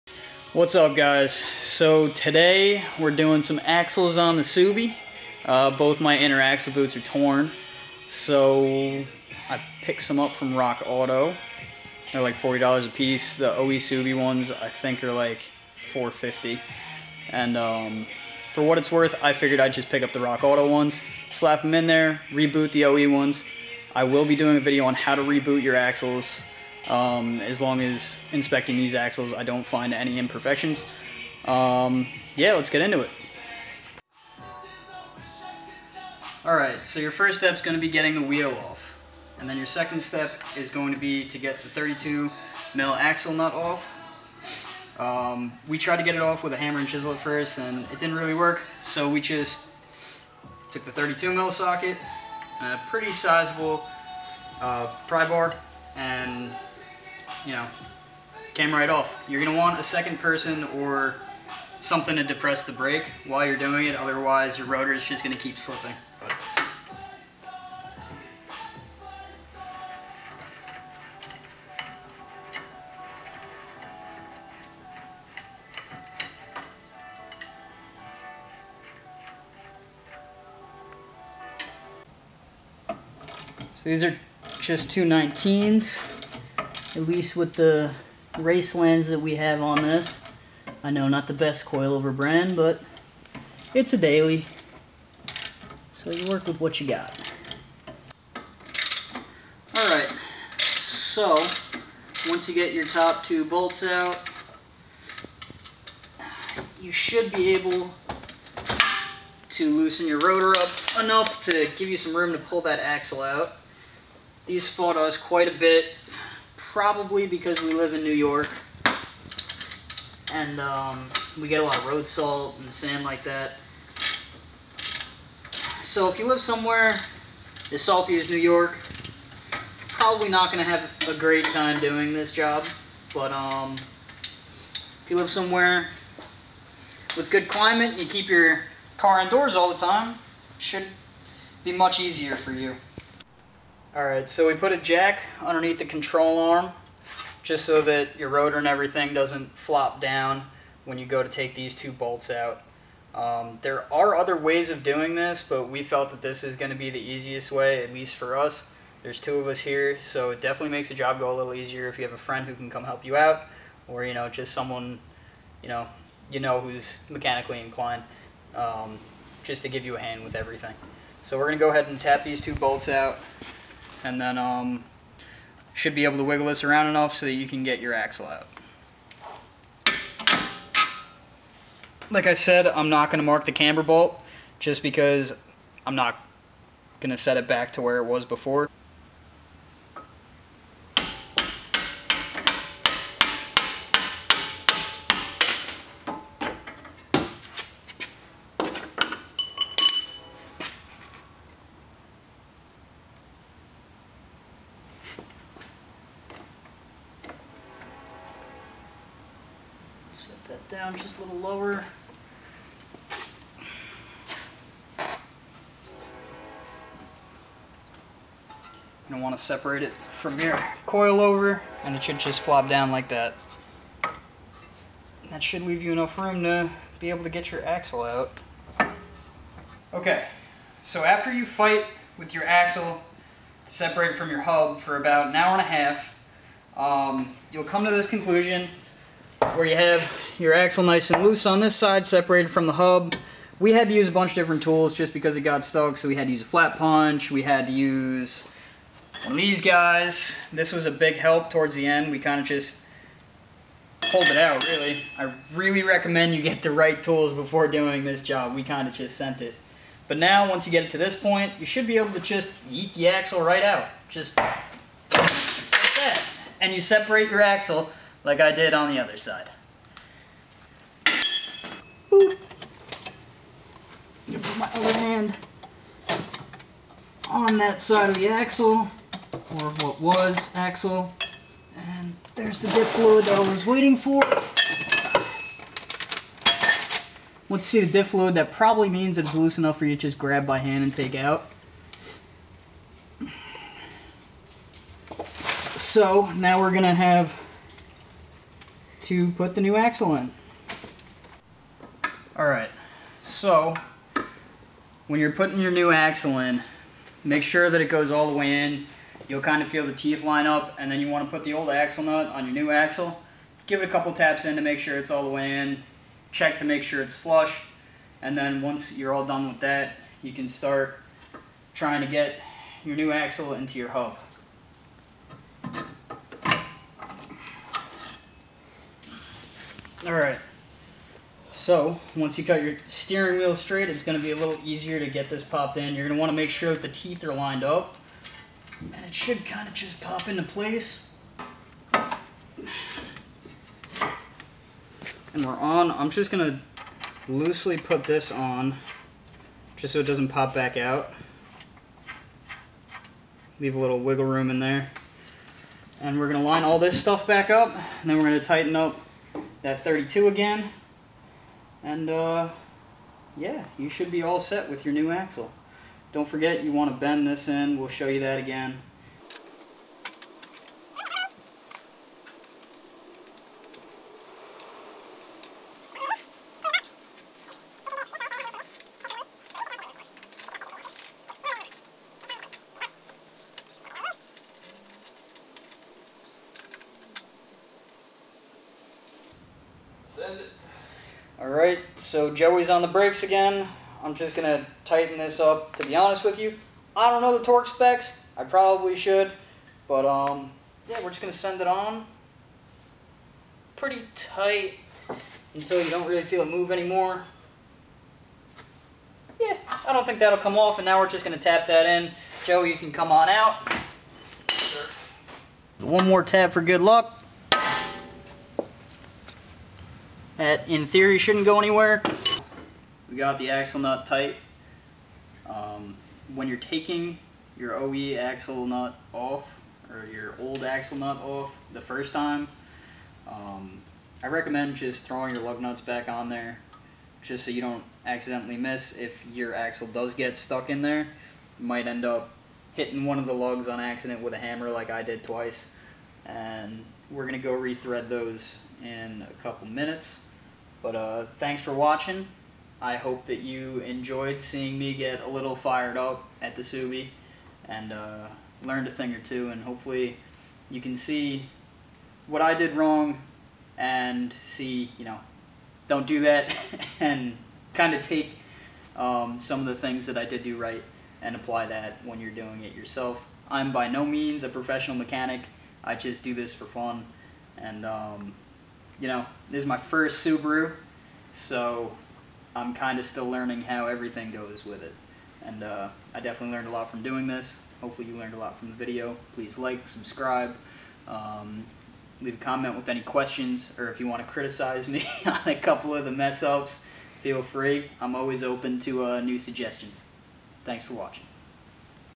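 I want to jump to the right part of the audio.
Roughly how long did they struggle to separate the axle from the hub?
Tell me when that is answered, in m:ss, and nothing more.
3:55.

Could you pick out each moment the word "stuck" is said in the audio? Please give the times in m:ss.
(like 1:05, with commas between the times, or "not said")
4:05, 7:20.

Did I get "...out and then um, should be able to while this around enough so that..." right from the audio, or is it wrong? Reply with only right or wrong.
wrong.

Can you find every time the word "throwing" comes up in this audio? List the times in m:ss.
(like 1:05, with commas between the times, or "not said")
7:15.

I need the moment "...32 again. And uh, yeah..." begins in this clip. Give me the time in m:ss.
5:59.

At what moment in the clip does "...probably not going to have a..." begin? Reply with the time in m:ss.
2:09.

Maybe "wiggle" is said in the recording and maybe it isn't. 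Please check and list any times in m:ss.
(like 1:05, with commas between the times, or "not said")
2:56, 5:53.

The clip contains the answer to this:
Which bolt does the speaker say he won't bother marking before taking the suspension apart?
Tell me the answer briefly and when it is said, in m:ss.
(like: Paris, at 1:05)
camber bolt, at 3:03.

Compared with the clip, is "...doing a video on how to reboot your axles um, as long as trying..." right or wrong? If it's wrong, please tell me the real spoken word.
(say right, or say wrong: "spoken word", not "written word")
wrong: "inspecting", not "trying".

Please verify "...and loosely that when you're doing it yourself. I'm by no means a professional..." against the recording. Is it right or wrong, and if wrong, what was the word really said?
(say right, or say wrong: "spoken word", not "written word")
wrong: "apply", not "loosely".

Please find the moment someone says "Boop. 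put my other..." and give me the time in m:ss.
4:32.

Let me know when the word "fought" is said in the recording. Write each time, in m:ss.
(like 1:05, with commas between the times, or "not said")
1:54.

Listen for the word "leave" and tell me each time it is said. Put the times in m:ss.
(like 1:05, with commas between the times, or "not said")
3:45, 5:53, 8:12.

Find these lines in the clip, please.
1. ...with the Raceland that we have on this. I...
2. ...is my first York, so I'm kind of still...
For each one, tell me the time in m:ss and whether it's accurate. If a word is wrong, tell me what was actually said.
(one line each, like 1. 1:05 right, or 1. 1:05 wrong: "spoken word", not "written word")
1. 1:27 right
2. 7:59 wrong: "Subaru", not "York".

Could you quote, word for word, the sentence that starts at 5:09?
You'll kind of feel the teeth line up, and then you want to put the old axle nut on your new axle.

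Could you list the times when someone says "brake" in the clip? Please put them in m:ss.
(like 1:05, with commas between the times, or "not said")
1:02, 6:32.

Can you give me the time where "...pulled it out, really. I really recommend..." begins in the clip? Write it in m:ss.
4:14.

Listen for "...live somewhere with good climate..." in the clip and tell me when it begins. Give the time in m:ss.
2:15.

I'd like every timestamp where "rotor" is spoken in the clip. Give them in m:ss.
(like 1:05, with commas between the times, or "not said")
1:04, 1:50, 2:28.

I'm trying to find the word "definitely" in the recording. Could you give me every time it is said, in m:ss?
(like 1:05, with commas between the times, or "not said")
2:40, 8:06.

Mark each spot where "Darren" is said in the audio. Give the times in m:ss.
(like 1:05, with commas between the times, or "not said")
not said.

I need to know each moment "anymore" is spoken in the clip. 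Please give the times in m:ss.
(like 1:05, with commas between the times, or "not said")
6:46.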